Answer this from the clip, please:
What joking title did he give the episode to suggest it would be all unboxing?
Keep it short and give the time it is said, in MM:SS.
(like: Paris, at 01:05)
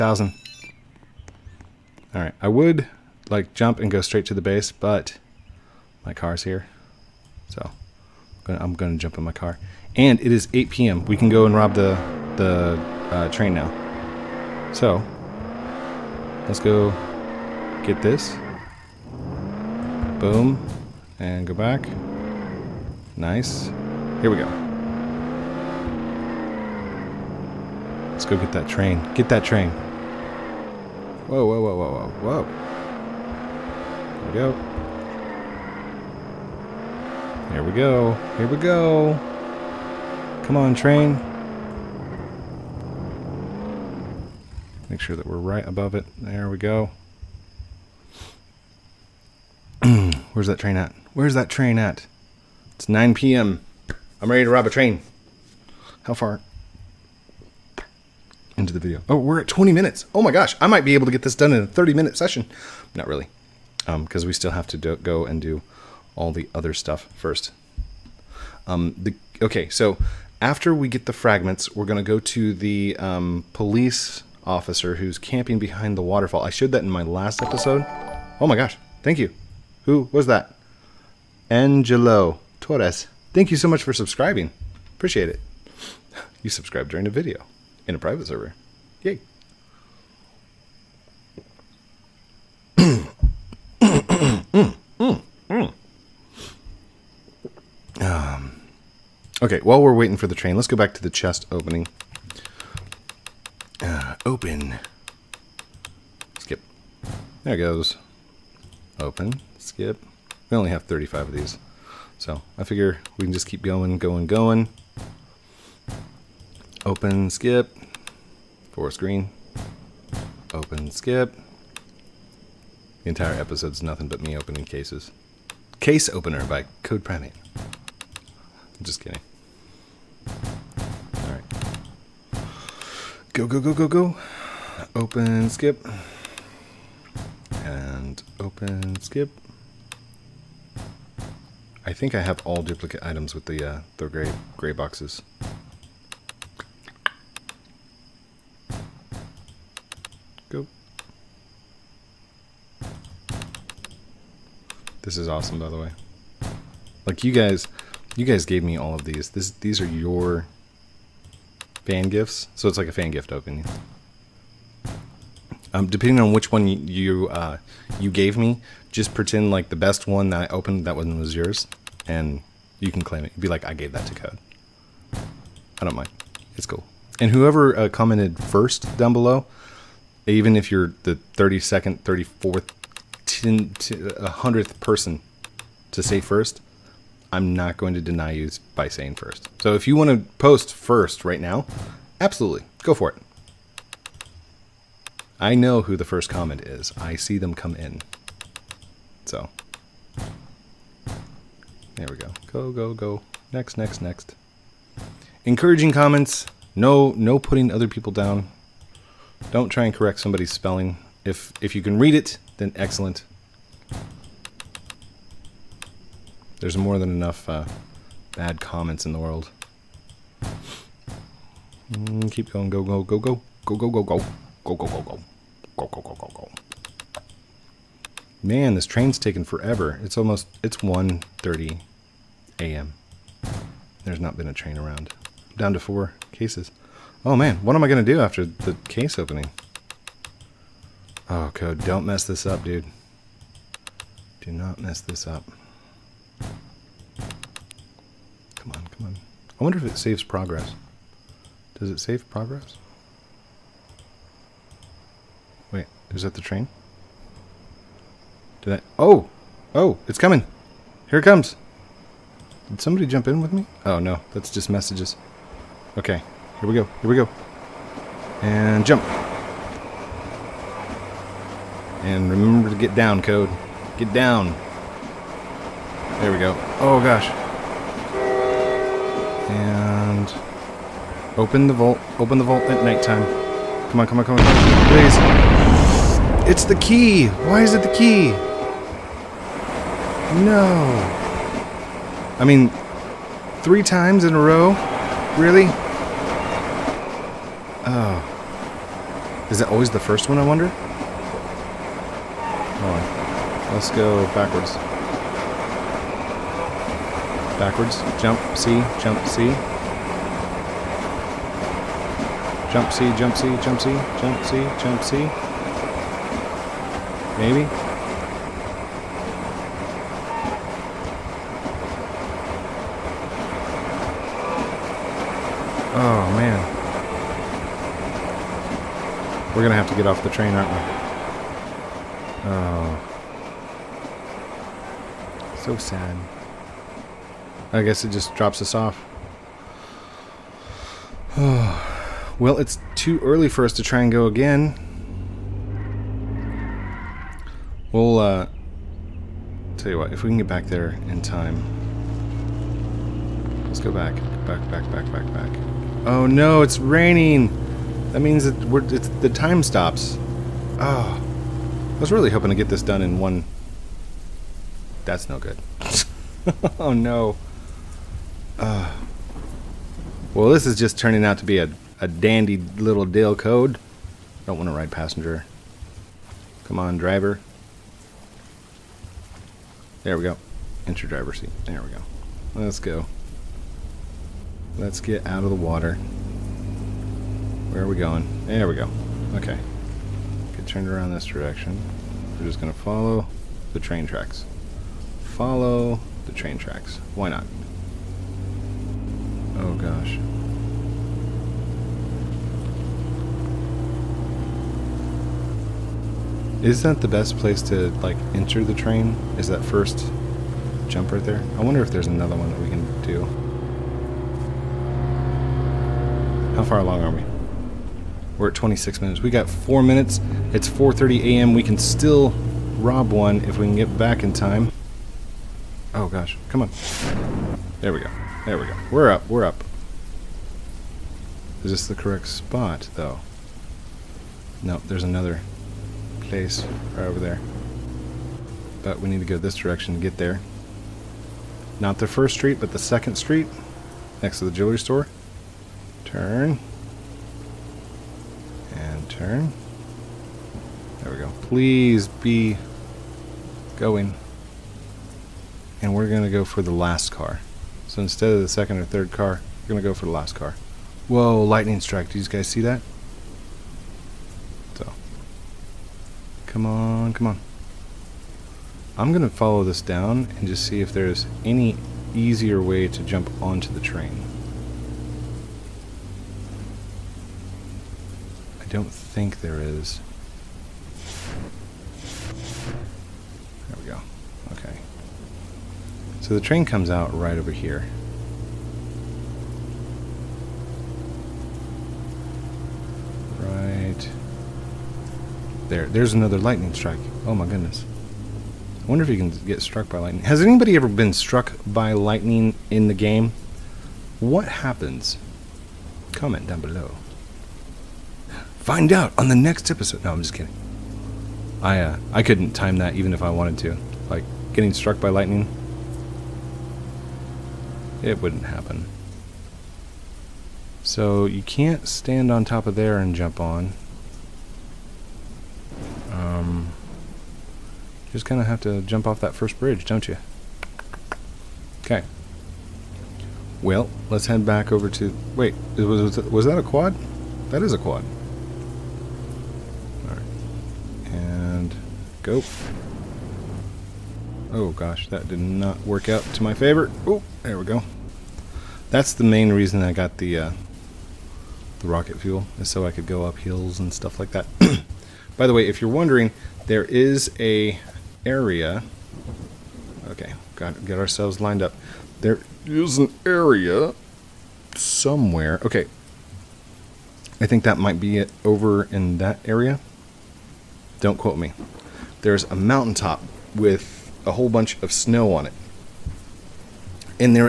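Case Opener, at 02:05.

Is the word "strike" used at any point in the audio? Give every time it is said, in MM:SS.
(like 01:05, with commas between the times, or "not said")
07:41, 08:16.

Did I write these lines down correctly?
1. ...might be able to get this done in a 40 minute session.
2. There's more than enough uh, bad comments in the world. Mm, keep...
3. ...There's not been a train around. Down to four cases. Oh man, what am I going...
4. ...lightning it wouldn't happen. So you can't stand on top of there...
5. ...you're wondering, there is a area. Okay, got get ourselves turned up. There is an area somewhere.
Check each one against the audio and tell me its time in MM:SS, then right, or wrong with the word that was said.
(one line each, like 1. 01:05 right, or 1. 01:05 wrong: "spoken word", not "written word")
1. 01:00 wrong: "30", not "40"
2. 03:36 right
3. 03:54 right
4. 08:35 right
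5. 09:15 wrong: "lined", not "turned".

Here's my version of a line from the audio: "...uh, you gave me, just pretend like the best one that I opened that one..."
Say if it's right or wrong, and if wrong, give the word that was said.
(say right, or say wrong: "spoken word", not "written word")
right.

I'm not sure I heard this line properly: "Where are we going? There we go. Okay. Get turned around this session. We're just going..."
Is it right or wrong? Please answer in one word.
wrong.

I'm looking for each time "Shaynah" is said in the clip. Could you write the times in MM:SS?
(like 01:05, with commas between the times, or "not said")
not said.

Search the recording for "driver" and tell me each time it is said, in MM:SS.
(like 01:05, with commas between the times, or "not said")
06:16, 06:21.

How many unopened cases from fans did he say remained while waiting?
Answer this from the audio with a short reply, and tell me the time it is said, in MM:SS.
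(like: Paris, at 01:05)
35, at 01:50.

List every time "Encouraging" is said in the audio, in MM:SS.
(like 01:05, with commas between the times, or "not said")
03:25.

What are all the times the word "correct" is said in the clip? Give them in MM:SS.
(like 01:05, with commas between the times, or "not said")
03:29, 07:11.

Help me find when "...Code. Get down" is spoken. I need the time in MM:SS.
04:33.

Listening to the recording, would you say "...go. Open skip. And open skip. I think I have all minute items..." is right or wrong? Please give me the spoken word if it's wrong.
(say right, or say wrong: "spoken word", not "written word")
wrong: "duplicate", not "minute".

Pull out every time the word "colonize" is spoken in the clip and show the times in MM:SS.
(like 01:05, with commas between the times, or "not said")
not said.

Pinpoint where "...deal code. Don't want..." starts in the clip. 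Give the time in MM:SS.
06:13.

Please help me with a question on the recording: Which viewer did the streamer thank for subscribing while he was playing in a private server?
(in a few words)
Angelo Torres.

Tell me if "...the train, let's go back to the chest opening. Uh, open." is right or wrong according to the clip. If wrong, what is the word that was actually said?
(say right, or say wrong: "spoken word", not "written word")
right.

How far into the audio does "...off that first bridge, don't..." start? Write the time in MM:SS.
08:49.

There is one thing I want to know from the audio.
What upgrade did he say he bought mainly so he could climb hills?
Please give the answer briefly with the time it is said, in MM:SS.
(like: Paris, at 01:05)
Rocket fuel, at 09:11.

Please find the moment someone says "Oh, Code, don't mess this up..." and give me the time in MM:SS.
04:01.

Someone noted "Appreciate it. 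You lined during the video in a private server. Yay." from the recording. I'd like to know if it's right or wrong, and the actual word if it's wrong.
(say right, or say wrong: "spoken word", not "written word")
wrong: "subscribed", not "lined".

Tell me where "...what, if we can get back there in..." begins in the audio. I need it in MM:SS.
05:49.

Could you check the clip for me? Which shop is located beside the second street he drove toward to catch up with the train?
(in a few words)
Jewelry store.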